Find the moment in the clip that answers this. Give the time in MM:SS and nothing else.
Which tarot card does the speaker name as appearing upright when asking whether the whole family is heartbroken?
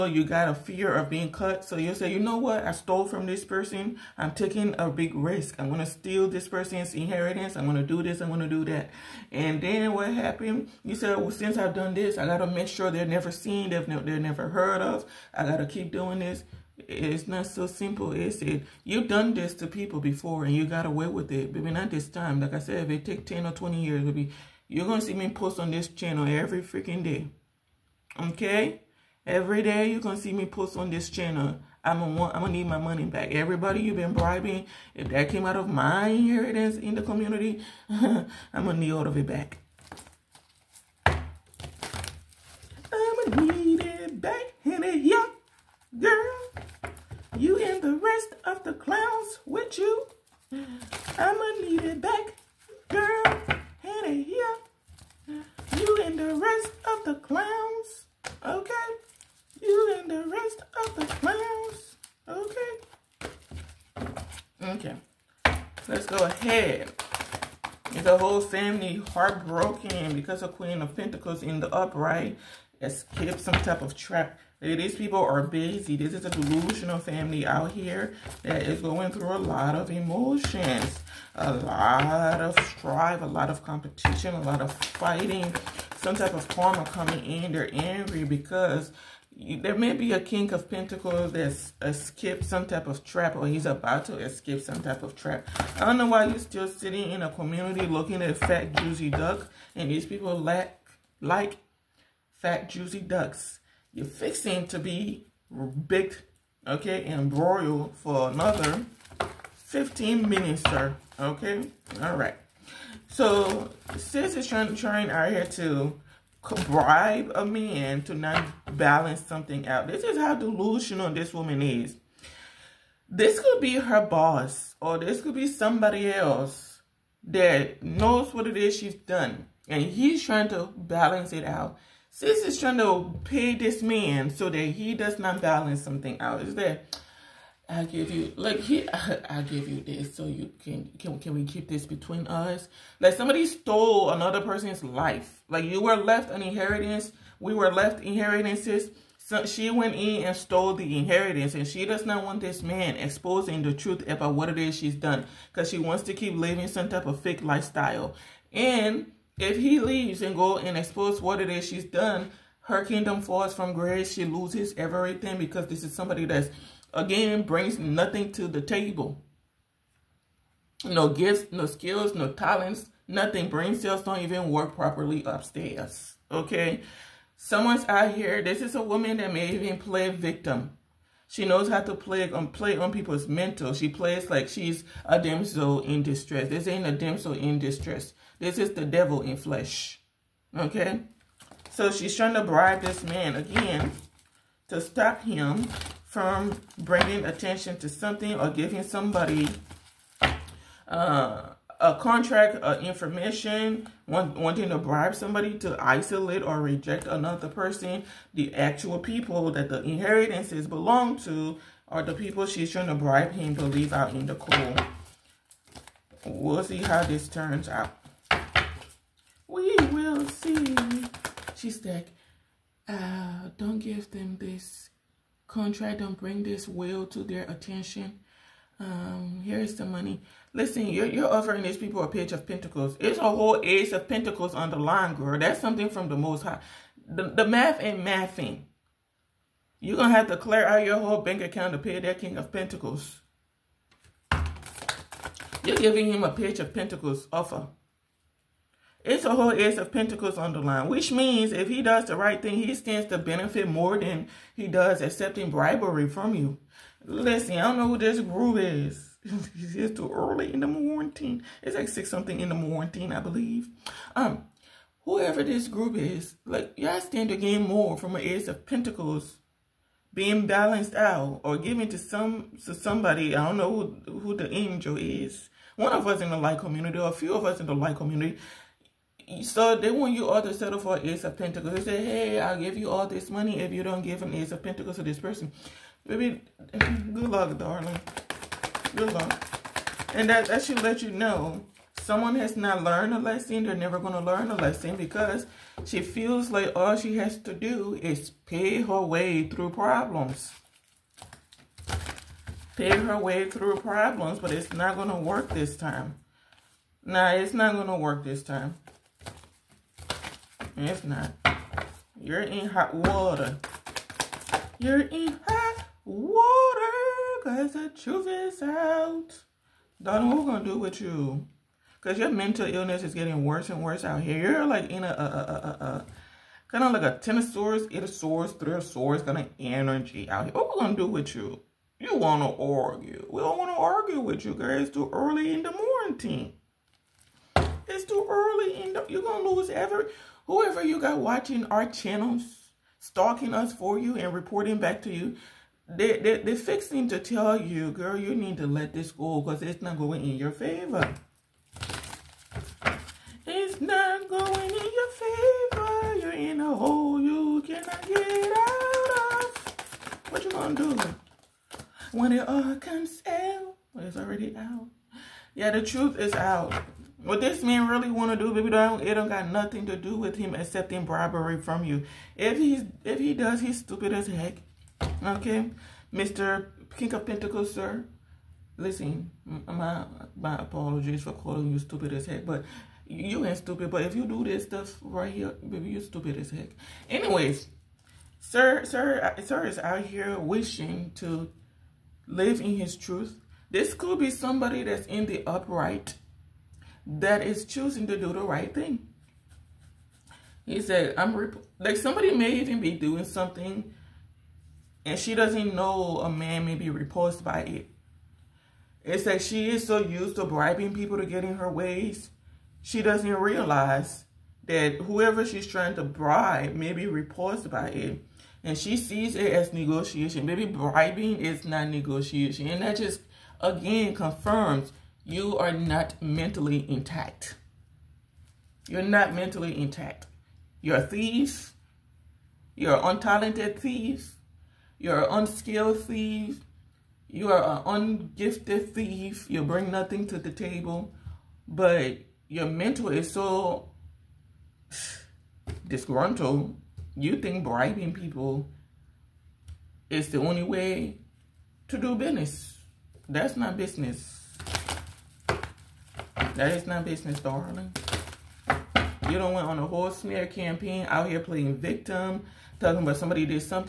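01:10.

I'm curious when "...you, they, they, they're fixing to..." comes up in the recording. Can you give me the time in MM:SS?
05:45.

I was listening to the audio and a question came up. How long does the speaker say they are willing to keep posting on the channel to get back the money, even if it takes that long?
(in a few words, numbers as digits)
10 or 20 years.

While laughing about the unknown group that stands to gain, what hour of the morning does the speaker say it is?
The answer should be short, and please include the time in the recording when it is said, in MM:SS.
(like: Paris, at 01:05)
six, at 04:21.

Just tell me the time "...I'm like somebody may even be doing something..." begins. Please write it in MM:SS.
06:41.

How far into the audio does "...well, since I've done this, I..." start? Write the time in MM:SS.
00:11.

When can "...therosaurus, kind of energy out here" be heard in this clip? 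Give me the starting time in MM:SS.
05:28.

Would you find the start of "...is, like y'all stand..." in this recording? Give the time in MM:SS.
04:25.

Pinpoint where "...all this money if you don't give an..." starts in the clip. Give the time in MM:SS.
04:42.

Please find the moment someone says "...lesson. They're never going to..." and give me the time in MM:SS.
04:53.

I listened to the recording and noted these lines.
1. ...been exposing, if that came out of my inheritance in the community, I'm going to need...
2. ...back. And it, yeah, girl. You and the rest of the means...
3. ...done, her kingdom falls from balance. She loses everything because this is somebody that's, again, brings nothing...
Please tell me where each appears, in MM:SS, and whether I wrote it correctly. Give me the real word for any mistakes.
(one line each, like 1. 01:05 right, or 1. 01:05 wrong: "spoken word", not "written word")
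1. 00:33 wrong: "bribing", not "exposing"
2. 00:44 wrong: "clowns", not "means"
3. 02:41 wrong: "grace", not "balance".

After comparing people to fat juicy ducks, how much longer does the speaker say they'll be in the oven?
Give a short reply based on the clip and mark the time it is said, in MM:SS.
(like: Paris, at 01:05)
15 minutes, at 01:49.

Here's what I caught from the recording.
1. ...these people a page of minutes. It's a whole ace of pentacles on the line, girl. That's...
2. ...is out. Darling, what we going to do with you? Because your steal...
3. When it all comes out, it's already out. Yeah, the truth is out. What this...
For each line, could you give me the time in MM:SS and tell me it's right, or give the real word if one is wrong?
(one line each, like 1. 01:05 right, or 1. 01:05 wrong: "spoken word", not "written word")
1. 03:51 wrong: "pentacles", not "minutes"
2. 05:18 wrong: "mental", not "steal"
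3. 06:02 right.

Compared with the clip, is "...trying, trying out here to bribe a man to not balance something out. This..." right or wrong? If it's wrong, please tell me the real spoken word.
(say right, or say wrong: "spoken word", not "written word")
right.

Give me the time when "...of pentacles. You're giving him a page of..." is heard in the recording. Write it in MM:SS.
04:02.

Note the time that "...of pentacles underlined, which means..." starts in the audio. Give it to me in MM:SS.
04:09.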